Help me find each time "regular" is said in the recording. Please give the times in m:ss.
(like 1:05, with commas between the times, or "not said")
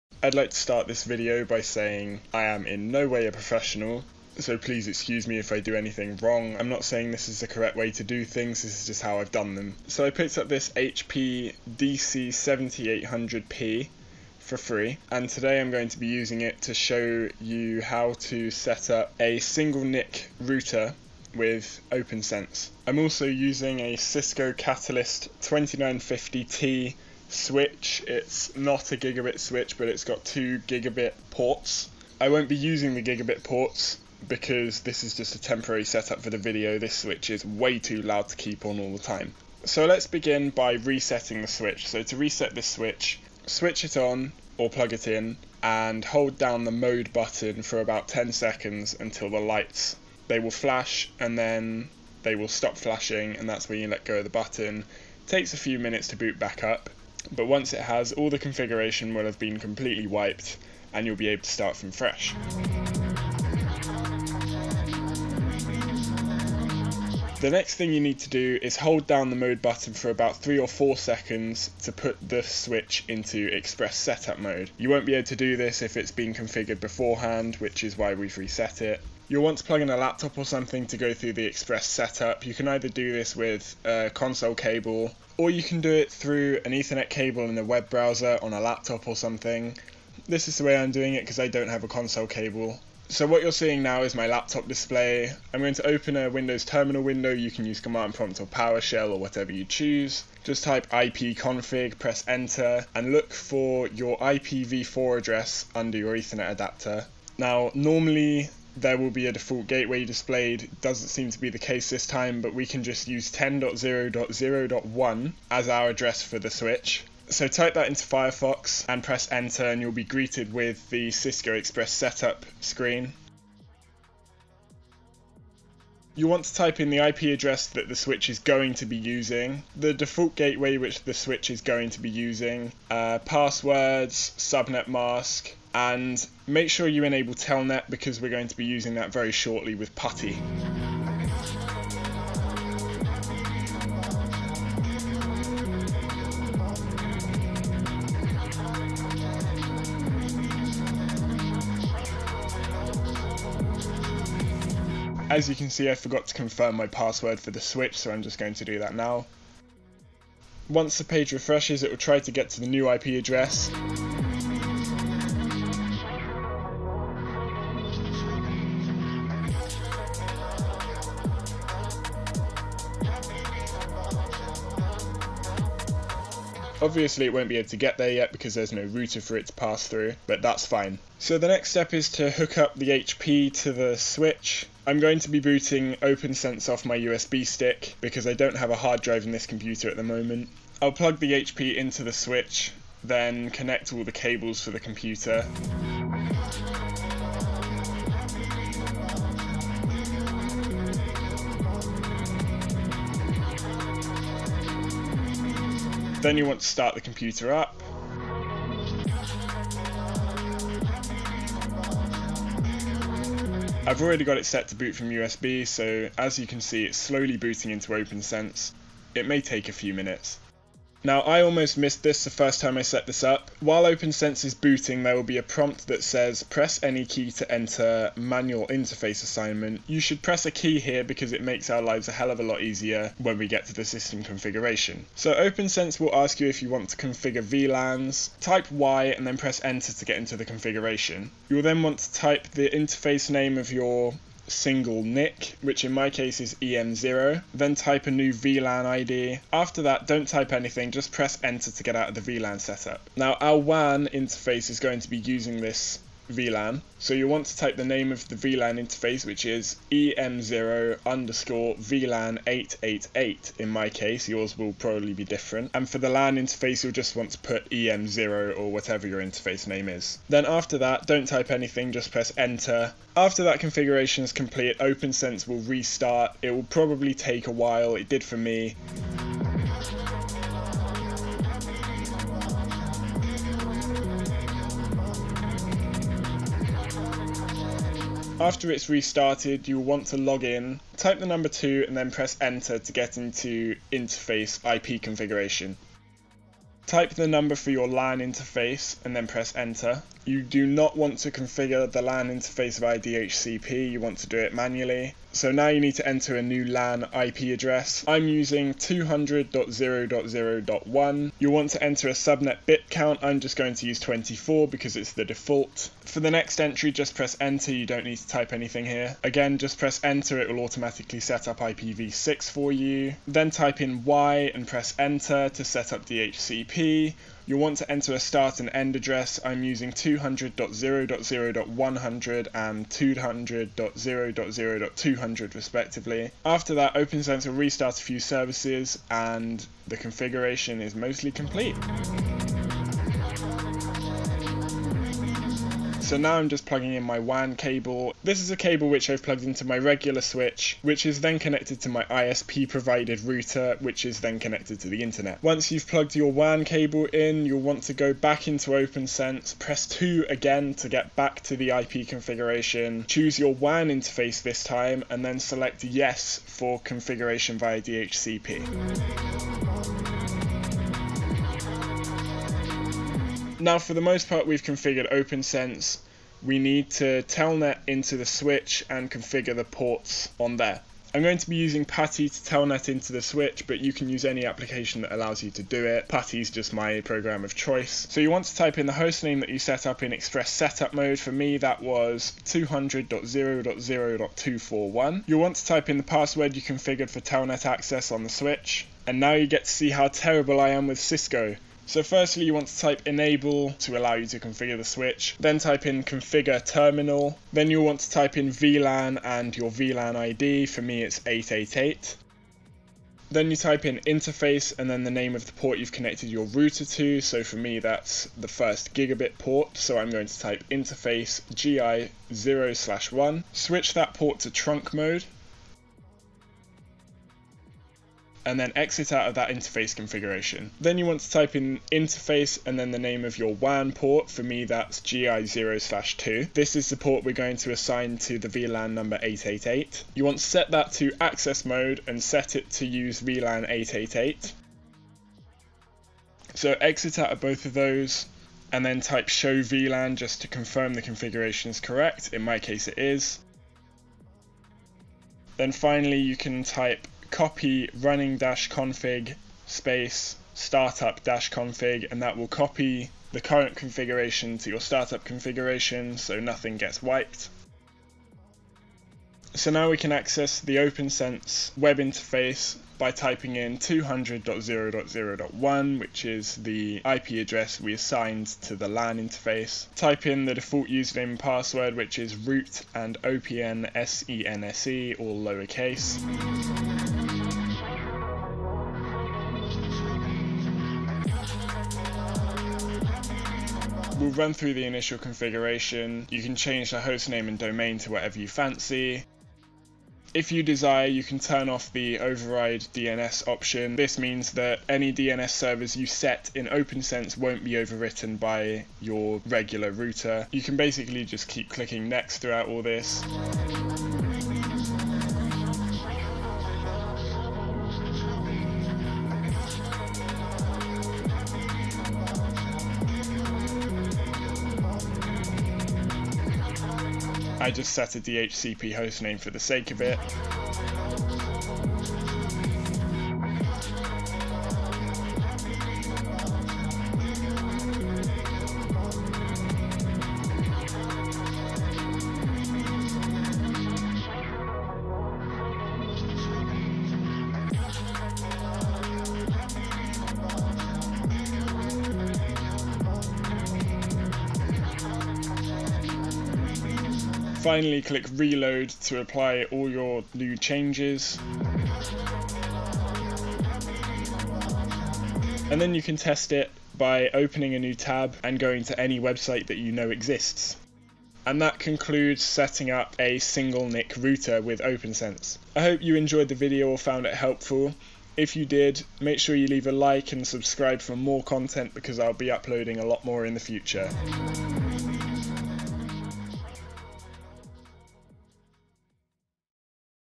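5:49, 8:29.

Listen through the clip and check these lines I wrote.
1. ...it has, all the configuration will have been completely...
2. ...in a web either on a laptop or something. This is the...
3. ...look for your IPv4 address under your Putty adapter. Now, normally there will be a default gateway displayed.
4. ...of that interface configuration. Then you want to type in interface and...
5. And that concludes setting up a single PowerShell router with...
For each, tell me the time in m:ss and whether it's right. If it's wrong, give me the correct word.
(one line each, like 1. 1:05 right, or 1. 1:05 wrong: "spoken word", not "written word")
1. 0:57 right
2. 1:27 wrong: "browser", not "either"
3. 1:43 wrong: "Ethernet", not "Putty"
4. 7:09 right
5. 9:31 wrong: "NIC", not "PowerShell".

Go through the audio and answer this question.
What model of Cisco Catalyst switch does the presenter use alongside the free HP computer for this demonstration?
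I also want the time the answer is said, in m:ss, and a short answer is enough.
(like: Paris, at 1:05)
2950T, at 0:25.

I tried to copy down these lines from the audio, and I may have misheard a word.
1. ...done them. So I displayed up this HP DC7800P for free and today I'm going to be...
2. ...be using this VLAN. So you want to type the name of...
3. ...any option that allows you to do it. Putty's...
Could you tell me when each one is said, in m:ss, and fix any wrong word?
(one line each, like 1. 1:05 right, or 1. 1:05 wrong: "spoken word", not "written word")
1. 0:09 wrong: "picked", not "displayed"
2. 4:15 right
3. 6:24 wrong: "application", not "option".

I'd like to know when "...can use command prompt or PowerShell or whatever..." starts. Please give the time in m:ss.
1:37.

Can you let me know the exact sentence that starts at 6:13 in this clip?
Now, for the most part, we've configured OPNsense.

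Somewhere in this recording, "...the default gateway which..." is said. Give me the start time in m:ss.
2:09.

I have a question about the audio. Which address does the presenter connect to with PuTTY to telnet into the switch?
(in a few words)
200.0.0.241.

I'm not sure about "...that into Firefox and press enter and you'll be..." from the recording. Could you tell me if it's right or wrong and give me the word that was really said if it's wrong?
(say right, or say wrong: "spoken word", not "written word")
right.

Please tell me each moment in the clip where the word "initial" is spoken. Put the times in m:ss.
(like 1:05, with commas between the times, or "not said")
8:14.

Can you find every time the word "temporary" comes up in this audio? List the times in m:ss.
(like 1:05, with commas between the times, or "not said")
0:35.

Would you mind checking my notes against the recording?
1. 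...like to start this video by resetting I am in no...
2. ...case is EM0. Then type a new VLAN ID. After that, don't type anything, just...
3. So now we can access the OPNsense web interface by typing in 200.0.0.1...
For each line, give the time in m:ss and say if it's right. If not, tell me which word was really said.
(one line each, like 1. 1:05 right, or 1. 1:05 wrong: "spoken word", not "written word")
1. 0:00 wrong: "saying", not "resetting"
2. 4:06 right
3. 7:49 right.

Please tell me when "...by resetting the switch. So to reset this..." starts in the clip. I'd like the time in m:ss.
0:40.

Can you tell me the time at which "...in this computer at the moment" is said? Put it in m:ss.
3:09.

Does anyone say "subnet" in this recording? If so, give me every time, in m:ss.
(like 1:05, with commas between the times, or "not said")
2:14, 5:12.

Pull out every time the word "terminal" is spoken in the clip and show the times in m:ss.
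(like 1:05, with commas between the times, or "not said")
1:36, 6:46.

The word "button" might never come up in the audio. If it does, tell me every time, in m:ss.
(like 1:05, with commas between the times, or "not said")
0:47, 0:54, 1:09.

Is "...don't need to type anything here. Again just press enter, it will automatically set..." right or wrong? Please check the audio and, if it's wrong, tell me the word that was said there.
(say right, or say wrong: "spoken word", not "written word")
right.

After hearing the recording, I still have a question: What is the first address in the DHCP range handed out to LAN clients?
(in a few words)
200.0.0.100.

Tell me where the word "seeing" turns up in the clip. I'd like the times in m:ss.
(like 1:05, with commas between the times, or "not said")
1:33.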